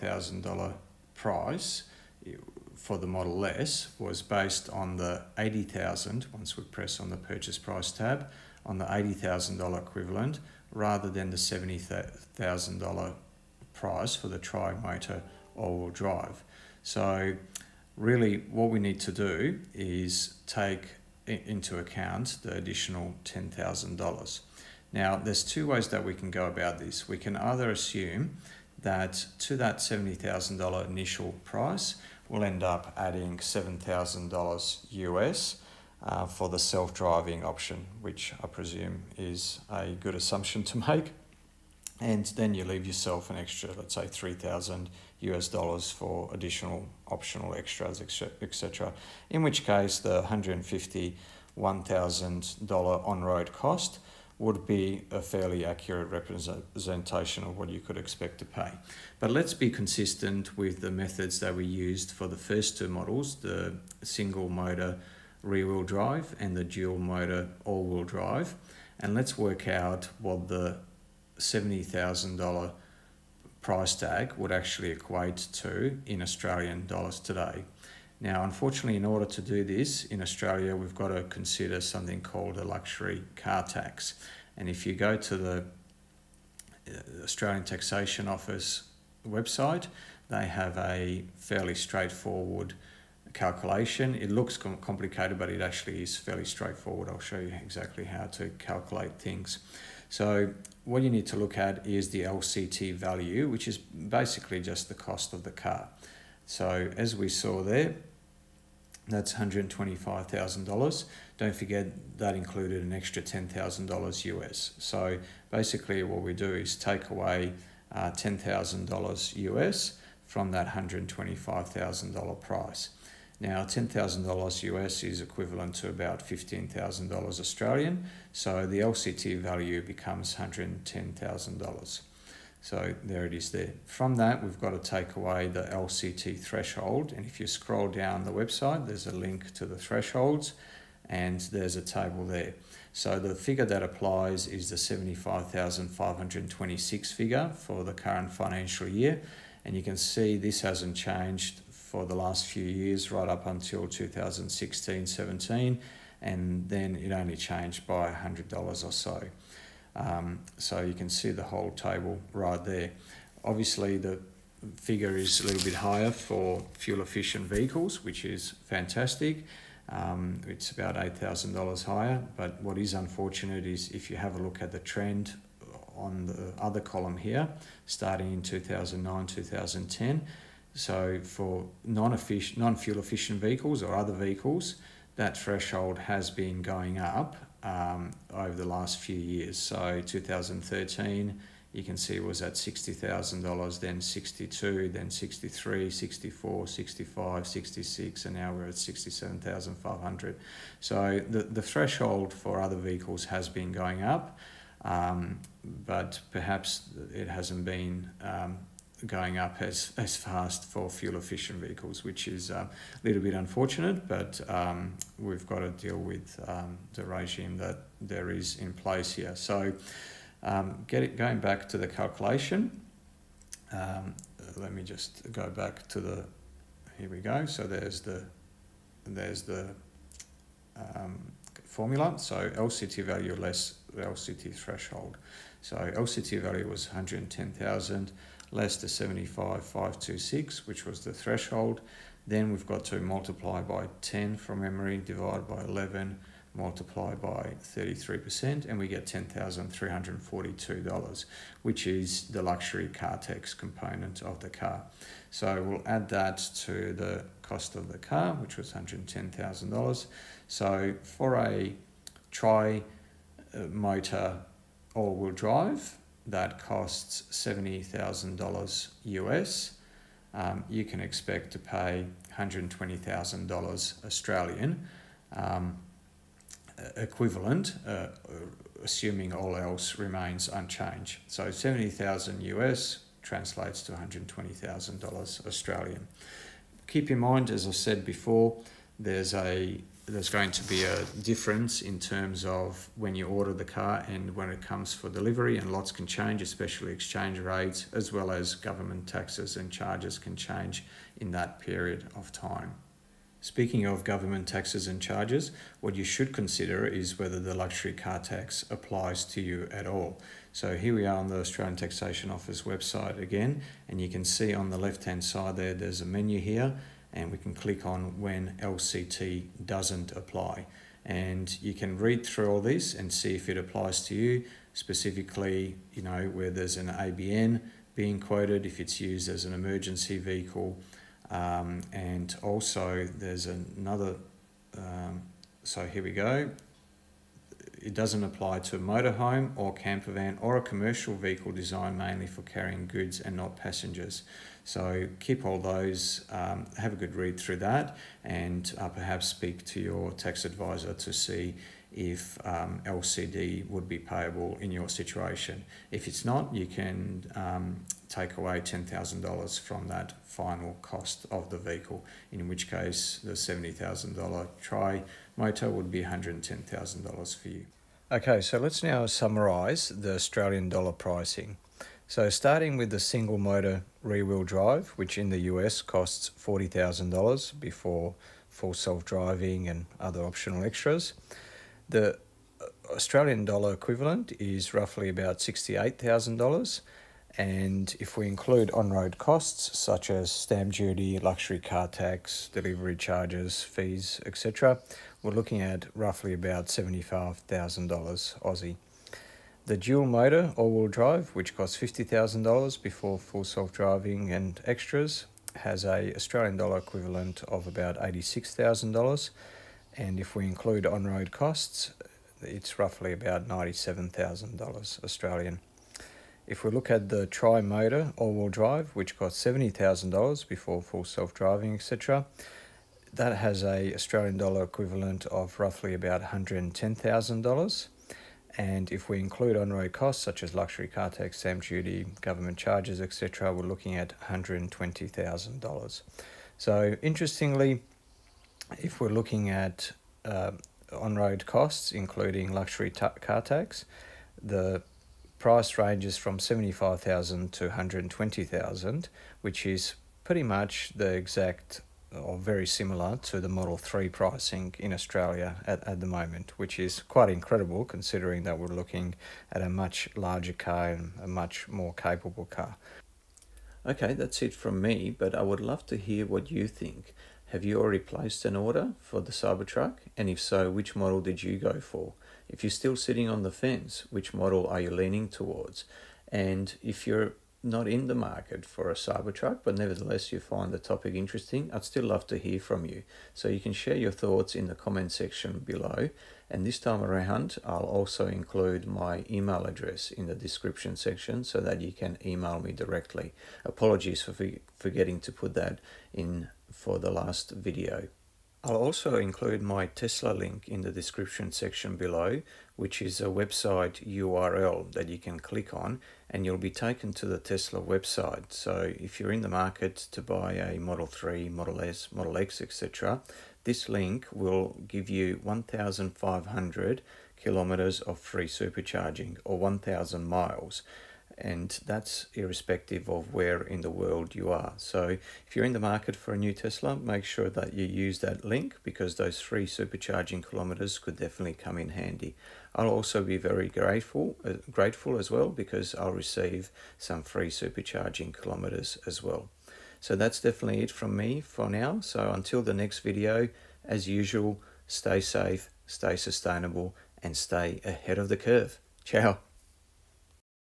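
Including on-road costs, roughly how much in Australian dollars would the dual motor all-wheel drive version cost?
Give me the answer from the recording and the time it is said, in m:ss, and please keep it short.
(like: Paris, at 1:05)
$97,000, at 6:53.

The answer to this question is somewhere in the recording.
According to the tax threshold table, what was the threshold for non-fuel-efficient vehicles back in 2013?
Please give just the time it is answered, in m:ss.
3:12.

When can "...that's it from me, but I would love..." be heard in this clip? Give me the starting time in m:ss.
7:44.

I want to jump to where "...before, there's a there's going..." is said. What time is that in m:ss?
4:48.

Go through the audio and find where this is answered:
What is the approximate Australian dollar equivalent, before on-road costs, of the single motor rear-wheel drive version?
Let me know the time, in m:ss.
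6:25.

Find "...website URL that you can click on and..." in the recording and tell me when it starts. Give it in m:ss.
8:23.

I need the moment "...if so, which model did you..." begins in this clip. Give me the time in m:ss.
7:50.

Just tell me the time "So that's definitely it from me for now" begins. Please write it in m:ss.
8:59.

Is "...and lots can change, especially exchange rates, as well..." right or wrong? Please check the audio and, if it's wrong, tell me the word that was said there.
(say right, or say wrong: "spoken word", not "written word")
right.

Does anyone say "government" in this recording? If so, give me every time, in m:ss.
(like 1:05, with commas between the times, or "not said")
4:58, 5:04, 7:12.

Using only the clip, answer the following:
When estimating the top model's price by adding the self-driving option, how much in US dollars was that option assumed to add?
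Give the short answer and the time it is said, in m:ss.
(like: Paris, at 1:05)
$7,000, at 0:33.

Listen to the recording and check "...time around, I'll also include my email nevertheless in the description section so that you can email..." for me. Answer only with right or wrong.
wrong.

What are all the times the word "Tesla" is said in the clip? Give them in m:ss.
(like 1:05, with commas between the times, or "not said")
8:19, 8:27, 8:46.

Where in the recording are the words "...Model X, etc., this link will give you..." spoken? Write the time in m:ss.
8:32.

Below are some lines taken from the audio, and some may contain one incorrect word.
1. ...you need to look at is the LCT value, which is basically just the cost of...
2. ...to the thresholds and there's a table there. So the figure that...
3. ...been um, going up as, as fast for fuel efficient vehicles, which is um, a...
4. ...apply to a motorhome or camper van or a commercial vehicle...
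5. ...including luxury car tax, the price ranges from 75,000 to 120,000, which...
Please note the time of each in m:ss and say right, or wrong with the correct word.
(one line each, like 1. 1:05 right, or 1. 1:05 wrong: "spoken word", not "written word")
1. 1:41 right
2. 2:19 right
3. 3:27 right
4. 5:38 right
5. 7:21 right.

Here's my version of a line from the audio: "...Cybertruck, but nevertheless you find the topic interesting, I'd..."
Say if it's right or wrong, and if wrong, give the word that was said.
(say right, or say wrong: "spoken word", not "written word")
right.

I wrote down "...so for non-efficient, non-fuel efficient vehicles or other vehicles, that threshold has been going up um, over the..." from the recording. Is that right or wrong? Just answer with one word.
right.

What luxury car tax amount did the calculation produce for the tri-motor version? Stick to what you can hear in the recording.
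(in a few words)
$10,342.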